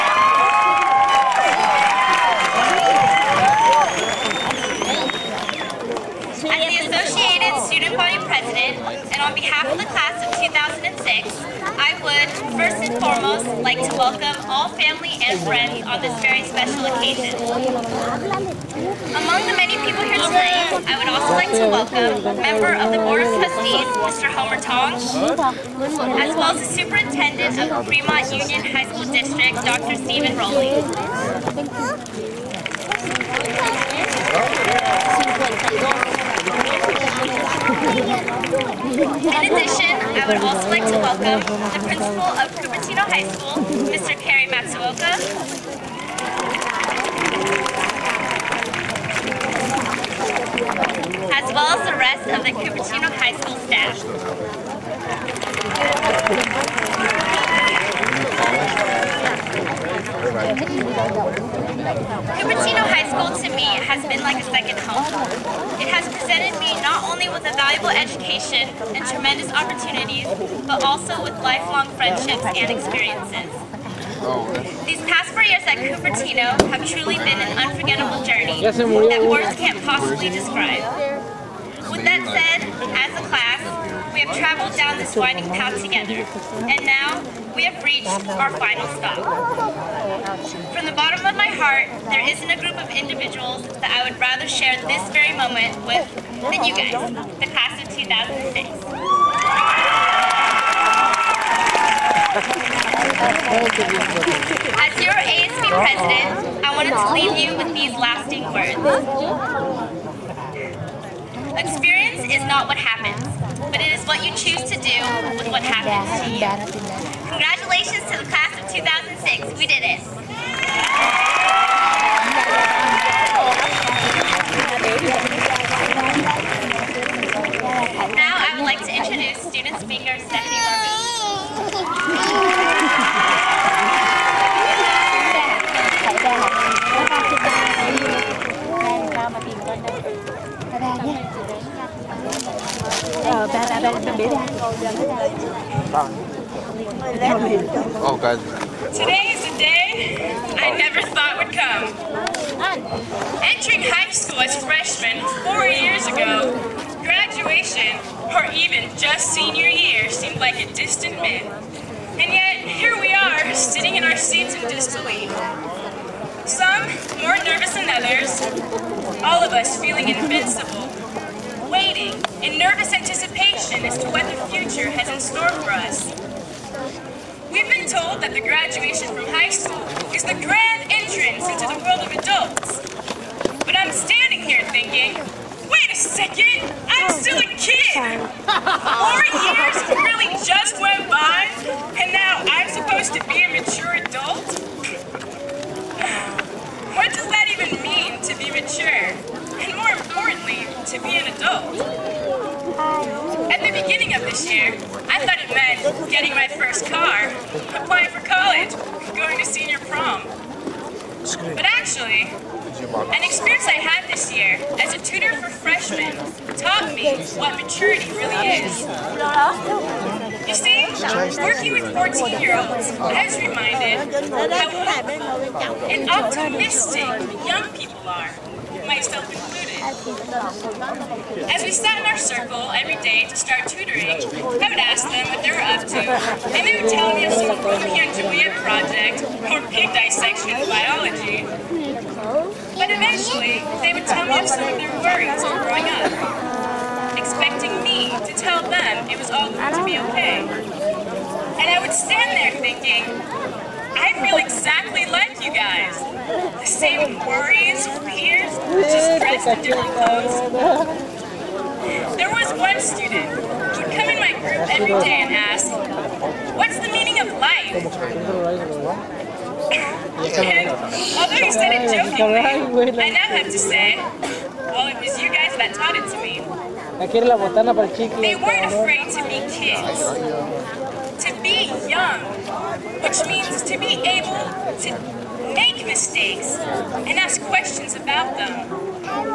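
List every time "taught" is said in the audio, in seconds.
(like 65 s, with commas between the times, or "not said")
216 s, 275 s.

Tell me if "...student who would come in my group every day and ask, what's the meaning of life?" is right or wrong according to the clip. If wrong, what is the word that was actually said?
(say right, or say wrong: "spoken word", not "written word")
right.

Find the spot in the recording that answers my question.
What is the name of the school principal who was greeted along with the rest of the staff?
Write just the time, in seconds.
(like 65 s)
44 s.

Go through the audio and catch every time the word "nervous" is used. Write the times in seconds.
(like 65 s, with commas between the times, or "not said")
167 s, 172 s.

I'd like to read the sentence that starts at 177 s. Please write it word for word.
We've been told that the graduation from high school is the grand entrance into the world of adults.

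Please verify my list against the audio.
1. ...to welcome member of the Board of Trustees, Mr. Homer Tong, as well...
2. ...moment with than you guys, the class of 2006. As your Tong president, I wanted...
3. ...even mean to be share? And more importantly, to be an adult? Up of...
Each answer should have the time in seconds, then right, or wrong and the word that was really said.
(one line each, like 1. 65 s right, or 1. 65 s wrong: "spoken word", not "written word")
1. 21 s right
2. 95 s wrong: "ASB", not "Tong"
3. 197 s wrong: "mature", not "share".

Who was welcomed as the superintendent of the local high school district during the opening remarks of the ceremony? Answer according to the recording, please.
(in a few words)
Dr. Stephen Rowley.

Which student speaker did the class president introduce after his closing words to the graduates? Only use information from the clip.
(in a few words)
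Stephanie Larby.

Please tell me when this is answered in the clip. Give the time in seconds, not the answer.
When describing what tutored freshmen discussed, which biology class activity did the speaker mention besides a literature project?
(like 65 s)
239 s.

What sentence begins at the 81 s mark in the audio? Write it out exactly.
With that said, as a class, we have traveled down this winding path together, and now we have reached our final stop.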